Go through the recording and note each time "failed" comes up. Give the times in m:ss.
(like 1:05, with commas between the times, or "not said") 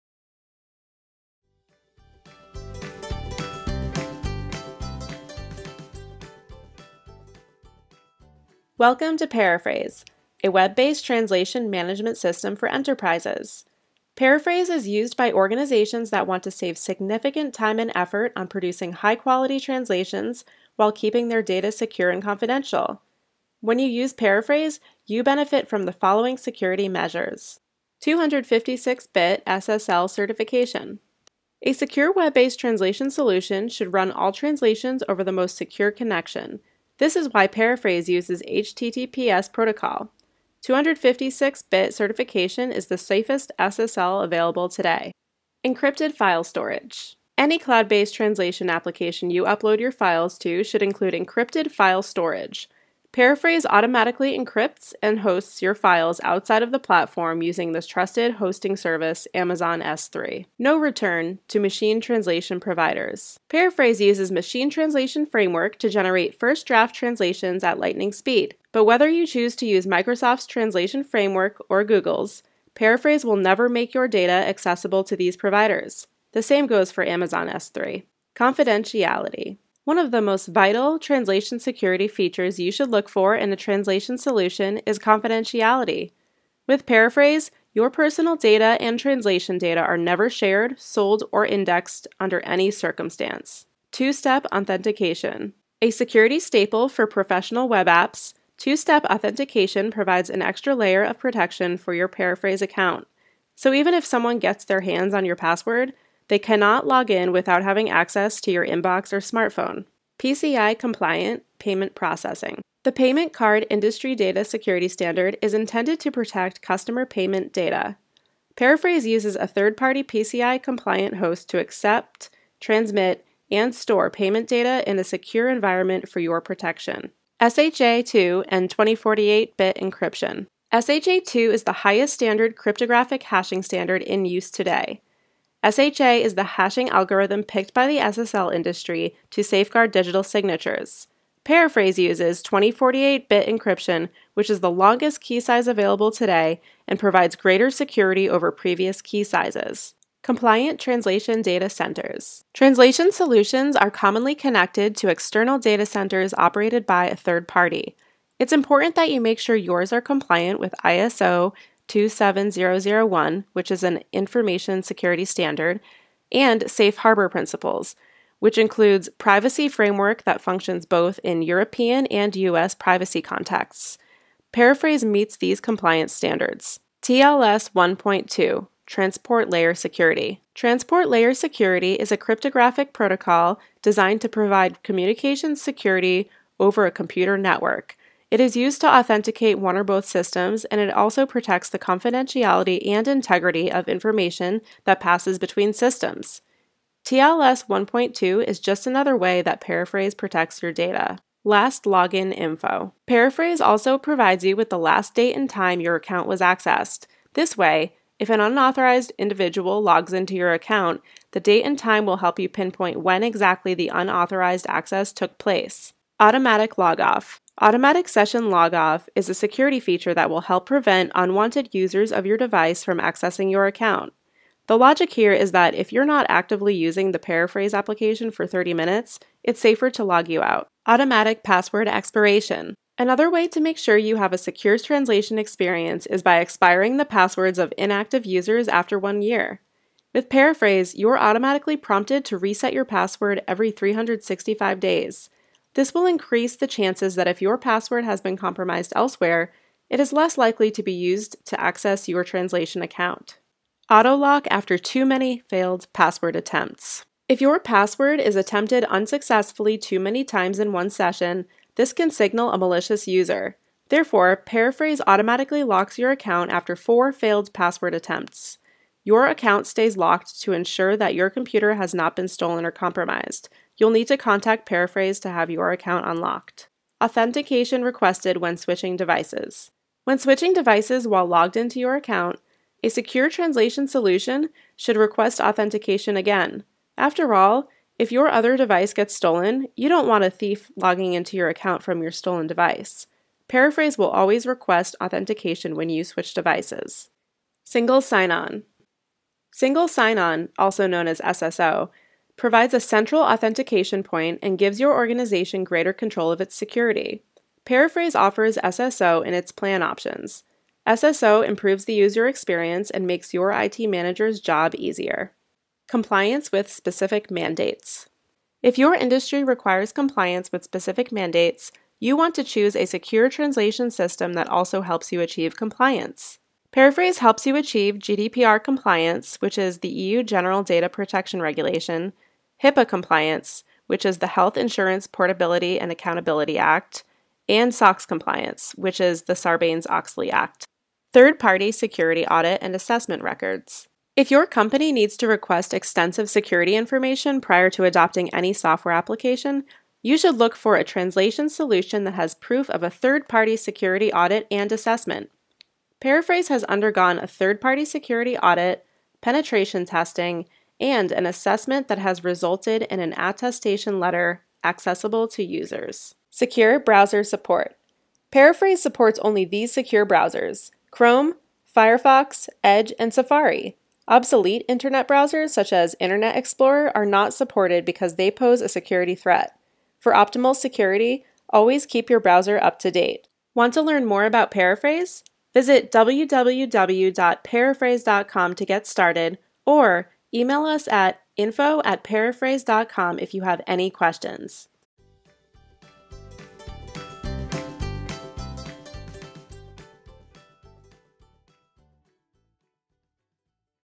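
4:15, 4:27.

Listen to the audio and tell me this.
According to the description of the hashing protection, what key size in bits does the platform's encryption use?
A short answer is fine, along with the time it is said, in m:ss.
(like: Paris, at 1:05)
2048, at 2:22.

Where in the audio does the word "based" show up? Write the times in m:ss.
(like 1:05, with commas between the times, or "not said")
0:10, 0:32, 0:47.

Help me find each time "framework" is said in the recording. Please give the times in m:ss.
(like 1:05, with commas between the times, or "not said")
1:05, 1:11, 2:49.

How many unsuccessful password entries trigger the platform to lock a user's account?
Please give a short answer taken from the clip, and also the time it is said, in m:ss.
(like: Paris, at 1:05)
4, at 4:26.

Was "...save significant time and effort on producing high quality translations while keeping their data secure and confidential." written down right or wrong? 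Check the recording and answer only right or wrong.
right.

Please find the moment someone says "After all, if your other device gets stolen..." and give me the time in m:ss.
4:46.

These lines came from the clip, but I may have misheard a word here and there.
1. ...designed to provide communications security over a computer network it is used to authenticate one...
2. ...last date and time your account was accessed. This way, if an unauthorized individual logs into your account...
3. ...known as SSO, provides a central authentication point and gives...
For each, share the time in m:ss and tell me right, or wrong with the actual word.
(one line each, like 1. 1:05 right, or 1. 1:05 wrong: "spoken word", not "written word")
1. 3:03 right
2. 3:24 right
3. 5:00 right.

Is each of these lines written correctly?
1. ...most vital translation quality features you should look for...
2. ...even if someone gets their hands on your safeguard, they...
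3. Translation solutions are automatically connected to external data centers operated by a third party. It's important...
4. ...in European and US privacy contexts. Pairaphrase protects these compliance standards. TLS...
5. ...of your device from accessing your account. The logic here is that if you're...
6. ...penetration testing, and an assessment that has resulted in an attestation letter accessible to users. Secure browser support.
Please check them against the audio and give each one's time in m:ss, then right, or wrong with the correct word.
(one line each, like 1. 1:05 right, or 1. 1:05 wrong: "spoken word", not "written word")
1. 1:20 wrong: "security", not "quality"
2. 1:43 wrong: "password", not "safeguard"
3. 2:32 wrong: "commonly", not "automatically"
4. 2:51 wrong: "meets", not "protects"
5. 3:42 right
6. 5:59 right.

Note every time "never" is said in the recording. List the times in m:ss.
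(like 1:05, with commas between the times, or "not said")
1:13, 1:29.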